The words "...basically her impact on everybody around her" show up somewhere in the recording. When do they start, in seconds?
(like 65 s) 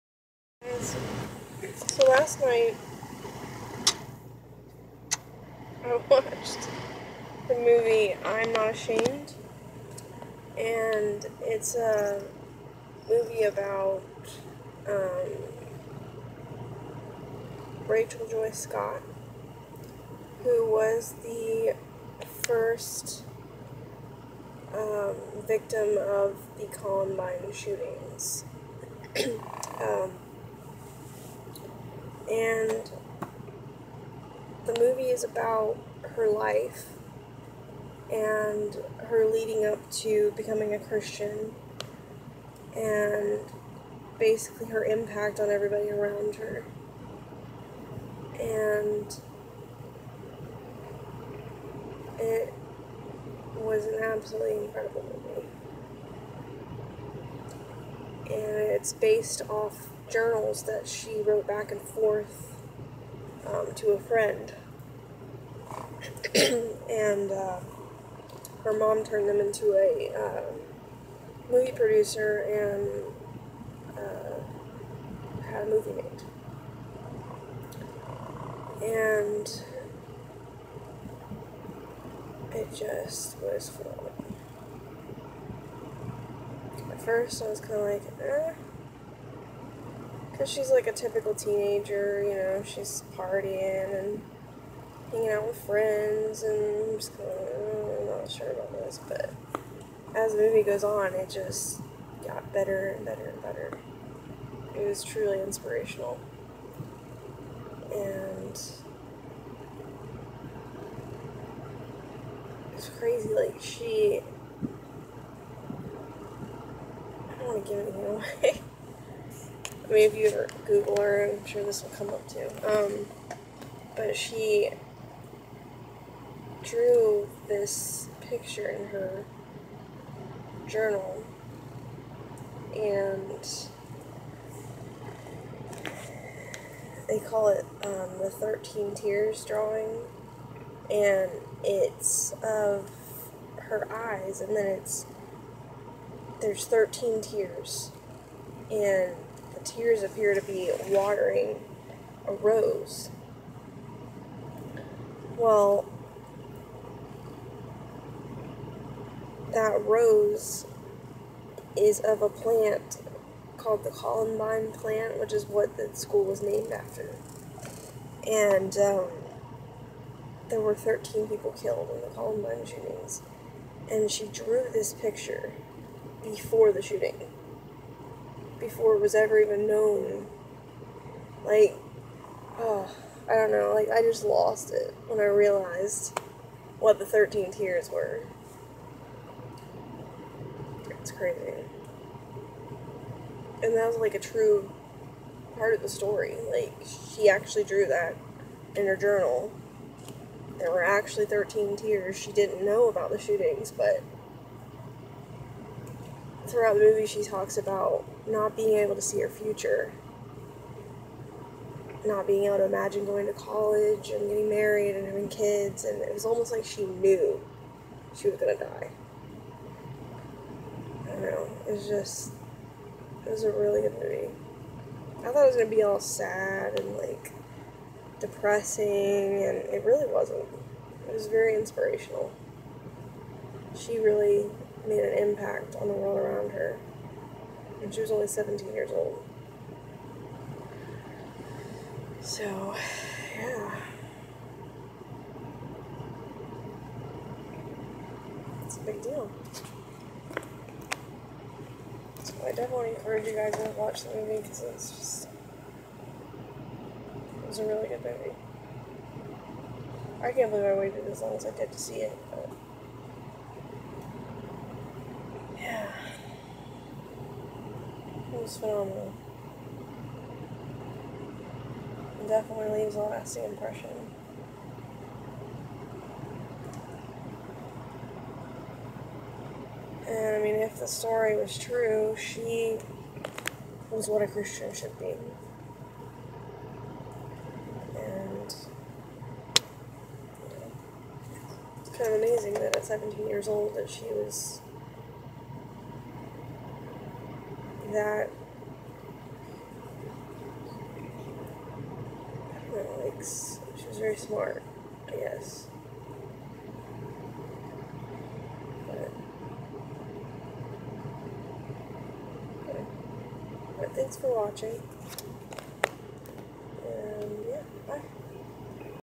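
44 s.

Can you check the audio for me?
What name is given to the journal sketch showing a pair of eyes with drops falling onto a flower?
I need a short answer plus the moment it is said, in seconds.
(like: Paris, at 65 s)
13 Tears drawing, at 138 s.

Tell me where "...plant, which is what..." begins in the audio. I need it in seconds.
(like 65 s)
164 s.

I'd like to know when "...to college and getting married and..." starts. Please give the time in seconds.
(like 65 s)
213 s.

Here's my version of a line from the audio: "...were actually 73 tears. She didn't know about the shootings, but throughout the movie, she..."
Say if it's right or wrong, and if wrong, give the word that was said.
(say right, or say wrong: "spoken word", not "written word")
wrong: "13", not "73".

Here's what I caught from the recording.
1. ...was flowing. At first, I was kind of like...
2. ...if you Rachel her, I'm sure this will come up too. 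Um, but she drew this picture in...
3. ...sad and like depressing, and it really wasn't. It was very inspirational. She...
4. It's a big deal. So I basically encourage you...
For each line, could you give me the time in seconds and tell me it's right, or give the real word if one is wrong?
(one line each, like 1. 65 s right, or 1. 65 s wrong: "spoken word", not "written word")
1. 83 s right
2. 120 s wrong: "Google", not "Rachel"
3. 226 s right
4. 248 s wrong: "definitely", not "basically".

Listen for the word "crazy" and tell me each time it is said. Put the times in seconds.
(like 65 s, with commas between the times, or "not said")
112 s, 191 s.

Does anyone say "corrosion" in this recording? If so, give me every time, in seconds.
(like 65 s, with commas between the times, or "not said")
not said.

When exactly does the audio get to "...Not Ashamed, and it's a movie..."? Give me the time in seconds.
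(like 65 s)
8 s.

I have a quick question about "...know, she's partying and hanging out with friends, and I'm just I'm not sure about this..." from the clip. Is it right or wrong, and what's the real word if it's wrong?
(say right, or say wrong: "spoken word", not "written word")
right.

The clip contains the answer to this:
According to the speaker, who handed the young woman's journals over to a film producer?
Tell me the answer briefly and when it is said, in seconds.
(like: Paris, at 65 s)
her mom, at 68 s.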